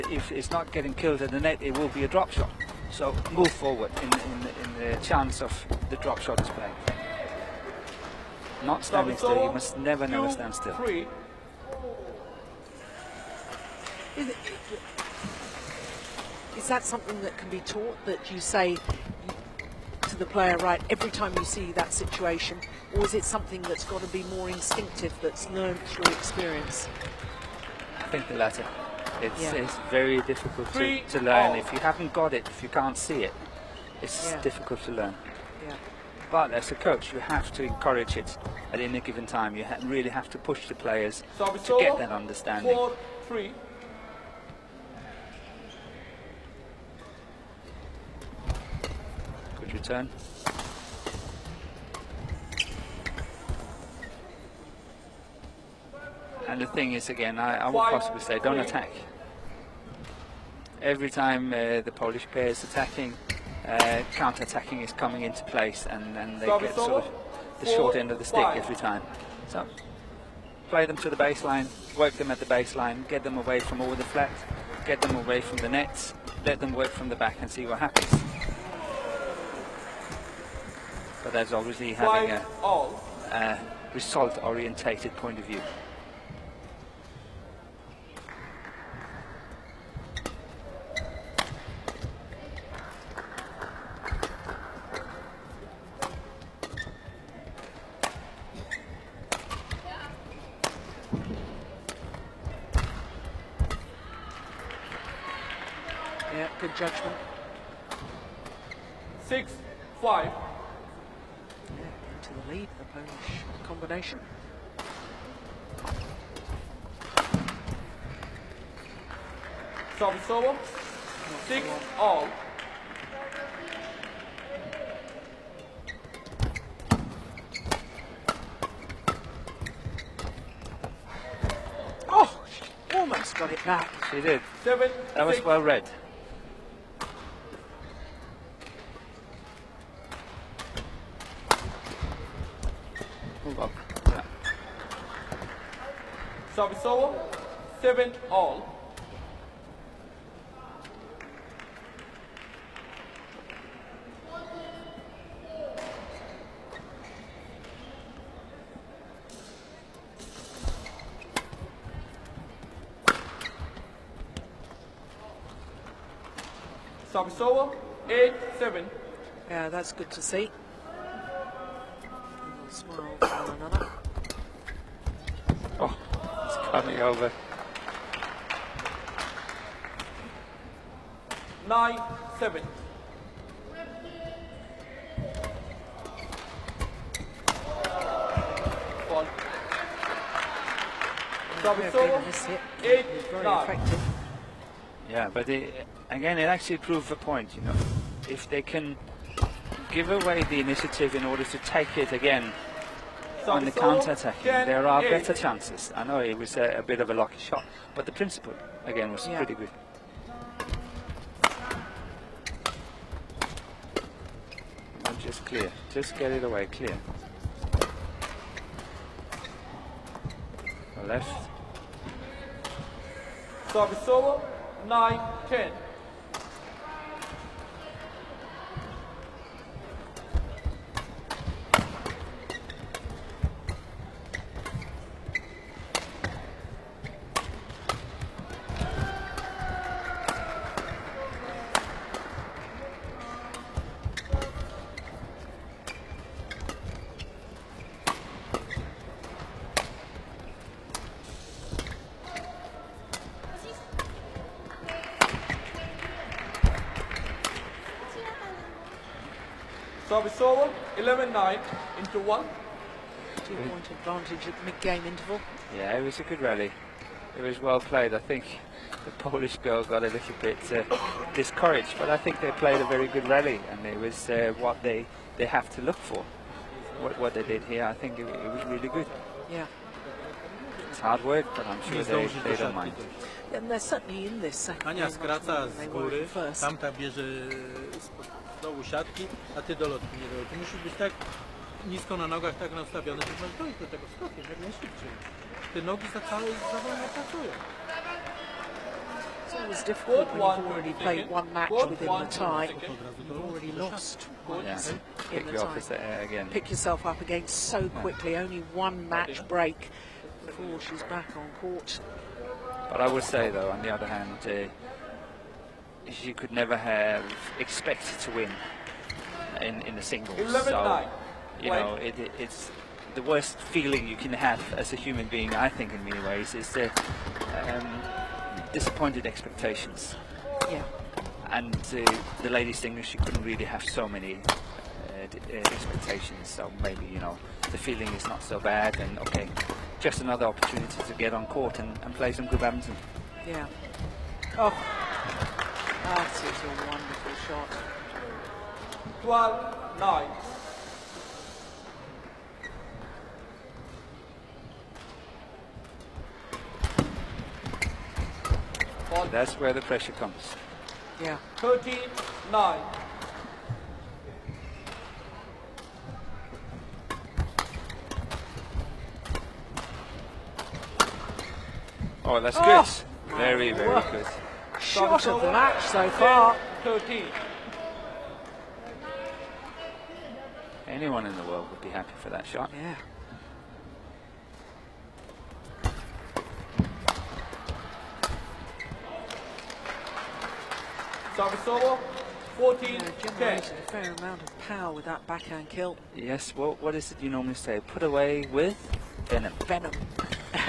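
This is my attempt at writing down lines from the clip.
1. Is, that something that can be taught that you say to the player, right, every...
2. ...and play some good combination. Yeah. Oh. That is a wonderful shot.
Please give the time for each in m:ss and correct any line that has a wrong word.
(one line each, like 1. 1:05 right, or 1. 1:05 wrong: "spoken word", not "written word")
1. 0:16 right
2. 5:42 wrong: "badminton", not "combination".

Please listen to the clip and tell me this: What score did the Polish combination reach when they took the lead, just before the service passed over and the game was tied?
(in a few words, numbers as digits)
6-5.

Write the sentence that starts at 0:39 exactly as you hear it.
You ha really have to push the players so to solo, get that understanding.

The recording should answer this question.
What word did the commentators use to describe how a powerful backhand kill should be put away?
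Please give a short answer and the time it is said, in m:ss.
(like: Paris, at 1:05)
venom, at 6:37.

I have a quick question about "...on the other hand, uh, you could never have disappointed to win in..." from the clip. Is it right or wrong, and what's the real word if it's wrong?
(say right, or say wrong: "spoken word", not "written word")
wrong: "expected", not "disappointed".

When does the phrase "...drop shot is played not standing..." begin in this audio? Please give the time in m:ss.
0:05.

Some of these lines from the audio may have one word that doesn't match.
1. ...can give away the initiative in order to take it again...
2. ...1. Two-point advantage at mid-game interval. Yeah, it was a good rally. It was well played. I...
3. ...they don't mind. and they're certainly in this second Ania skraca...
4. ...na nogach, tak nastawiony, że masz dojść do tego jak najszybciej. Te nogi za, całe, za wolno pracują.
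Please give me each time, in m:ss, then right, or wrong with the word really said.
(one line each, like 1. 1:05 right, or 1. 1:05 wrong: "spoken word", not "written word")
1. 3:18 right
2. 4:22 right
3. 4:42 right
4. 4:52 right.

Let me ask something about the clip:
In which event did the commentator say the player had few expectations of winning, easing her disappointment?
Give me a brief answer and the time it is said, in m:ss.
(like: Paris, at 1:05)
ladies' singles, at 5:32.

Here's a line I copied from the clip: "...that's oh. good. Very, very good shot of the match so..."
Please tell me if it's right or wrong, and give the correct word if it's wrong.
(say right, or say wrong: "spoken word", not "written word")
right.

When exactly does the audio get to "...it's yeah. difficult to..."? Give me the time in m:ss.
0:34.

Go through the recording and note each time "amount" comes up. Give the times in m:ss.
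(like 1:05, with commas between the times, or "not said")
6:34.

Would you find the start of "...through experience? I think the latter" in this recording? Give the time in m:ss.
0:25.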